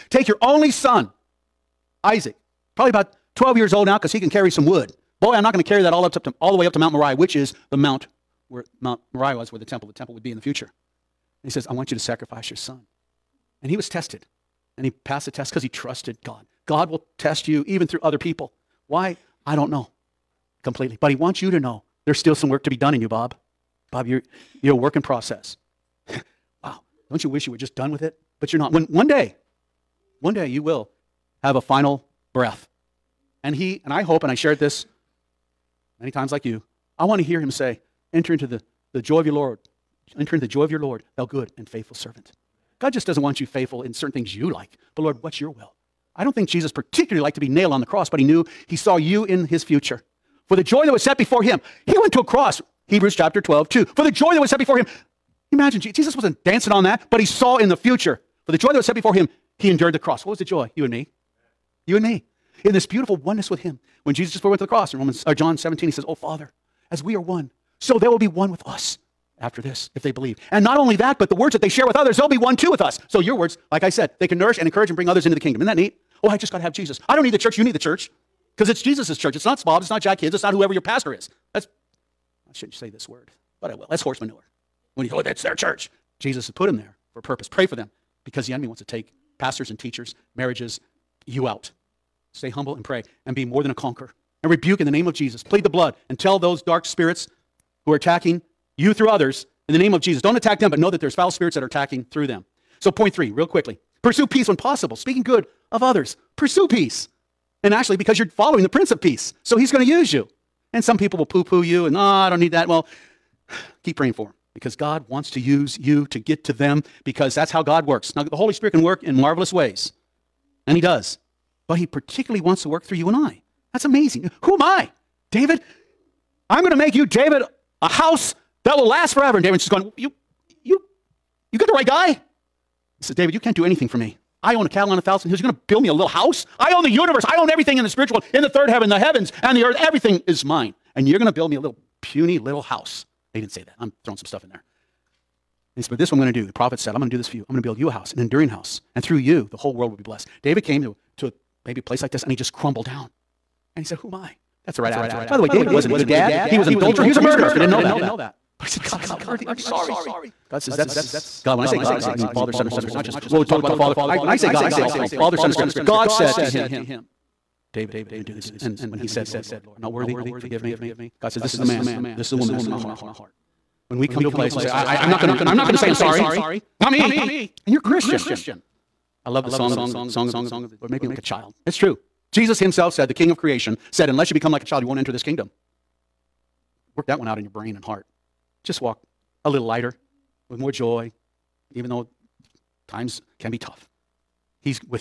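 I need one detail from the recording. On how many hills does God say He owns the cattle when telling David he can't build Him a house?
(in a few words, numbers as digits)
1000.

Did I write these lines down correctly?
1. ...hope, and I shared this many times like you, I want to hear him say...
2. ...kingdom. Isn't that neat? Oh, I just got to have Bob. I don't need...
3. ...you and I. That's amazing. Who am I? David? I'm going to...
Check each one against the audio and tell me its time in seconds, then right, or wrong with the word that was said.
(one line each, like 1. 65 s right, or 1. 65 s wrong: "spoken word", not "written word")
1. 34 s right
2. 75 s wrong: "Jesus", not "Bob"
3. 122 s right.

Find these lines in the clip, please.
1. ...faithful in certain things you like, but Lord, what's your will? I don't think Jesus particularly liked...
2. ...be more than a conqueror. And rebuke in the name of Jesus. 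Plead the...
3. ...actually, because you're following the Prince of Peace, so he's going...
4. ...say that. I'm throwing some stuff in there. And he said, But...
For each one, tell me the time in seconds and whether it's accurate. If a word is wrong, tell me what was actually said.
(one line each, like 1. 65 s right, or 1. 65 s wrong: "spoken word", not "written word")
1. 43 s right
2. 93 s right
3. 107 s right
4. 143 s right.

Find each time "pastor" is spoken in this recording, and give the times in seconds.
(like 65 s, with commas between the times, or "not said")
80 s, 89 s.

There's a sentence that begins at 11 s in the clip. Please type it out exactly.
And he says, I want you to sacrifice your son.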